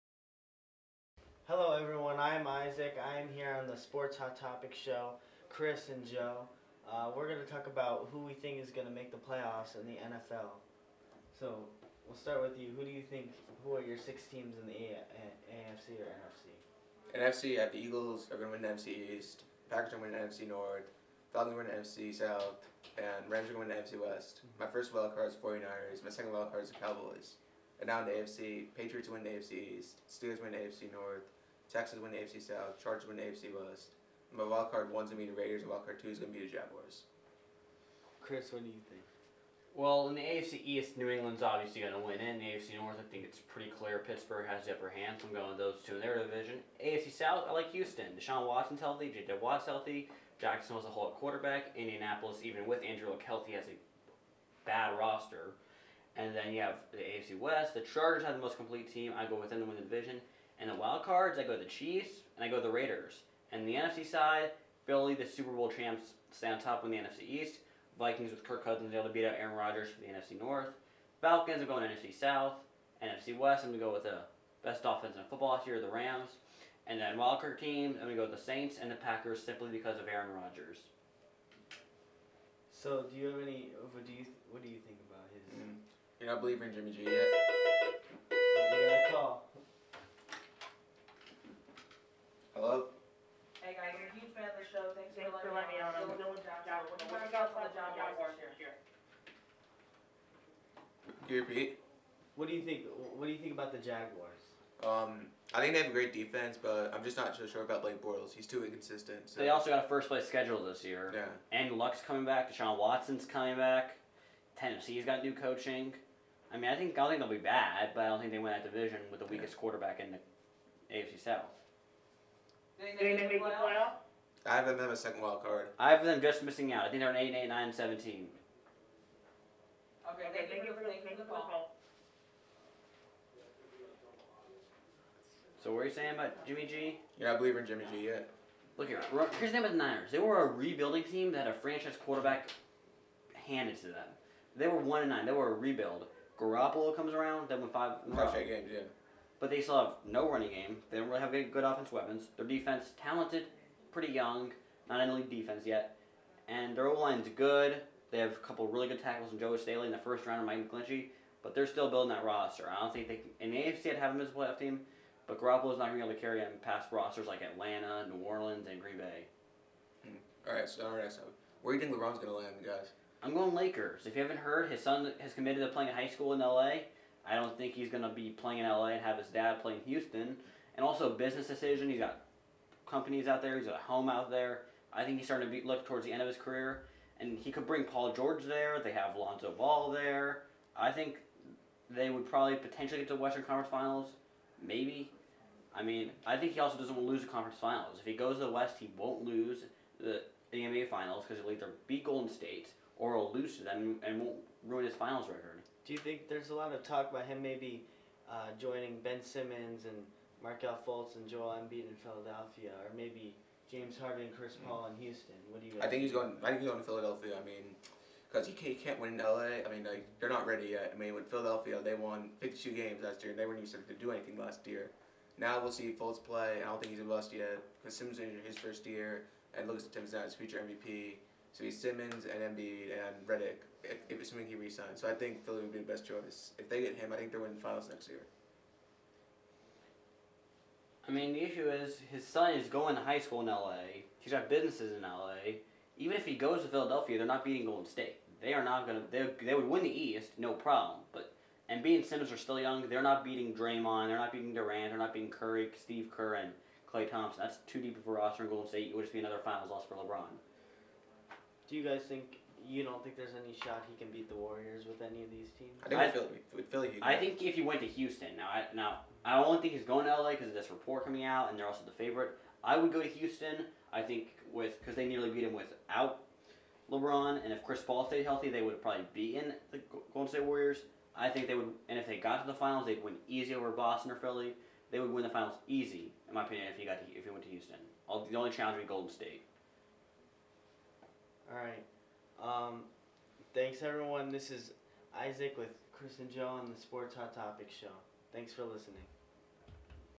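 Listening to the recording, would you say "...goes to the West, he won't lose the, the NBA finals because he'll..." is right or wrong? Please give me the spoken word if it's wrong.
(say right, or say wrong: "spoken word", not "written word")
right.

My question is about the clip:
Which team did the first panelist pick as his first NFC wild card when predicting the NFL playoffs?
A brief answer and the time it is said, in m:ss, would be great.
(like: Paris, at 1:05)
49ers, at 0:25.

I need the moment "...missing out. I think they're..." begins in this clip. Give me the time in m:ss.
2:06.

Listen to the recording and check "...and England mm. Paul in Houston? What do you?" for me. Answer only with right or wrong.
wrong.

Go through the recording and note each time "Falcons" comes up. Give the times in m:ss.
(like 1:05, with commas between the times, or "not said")
0:21, 1:11.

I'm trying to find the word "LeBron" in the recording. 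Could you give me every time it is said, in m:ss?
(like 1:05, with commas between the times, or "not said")
2:51, 4:19, 4:36.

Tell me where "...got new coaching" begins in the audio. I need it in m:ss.
1:55.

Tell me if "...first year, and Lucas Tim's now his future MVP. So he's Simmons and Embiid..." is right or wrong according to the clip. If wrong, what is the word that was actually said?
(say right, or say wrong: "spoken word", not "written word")
right.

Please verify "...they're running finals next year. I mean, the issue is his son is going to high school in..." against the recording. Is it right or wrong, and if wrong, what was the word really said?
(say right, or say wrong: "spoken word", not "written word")
wrong: "winning", not "running".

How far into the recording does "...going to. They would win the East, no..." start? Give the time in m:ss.
4:08.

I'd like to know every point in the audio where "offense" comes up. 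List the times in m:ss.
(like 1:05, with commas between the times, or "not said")
1:14, 2:31.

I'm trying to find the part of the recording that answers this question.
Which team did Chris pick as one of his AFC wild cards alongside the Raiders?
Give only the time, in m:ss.
1:01.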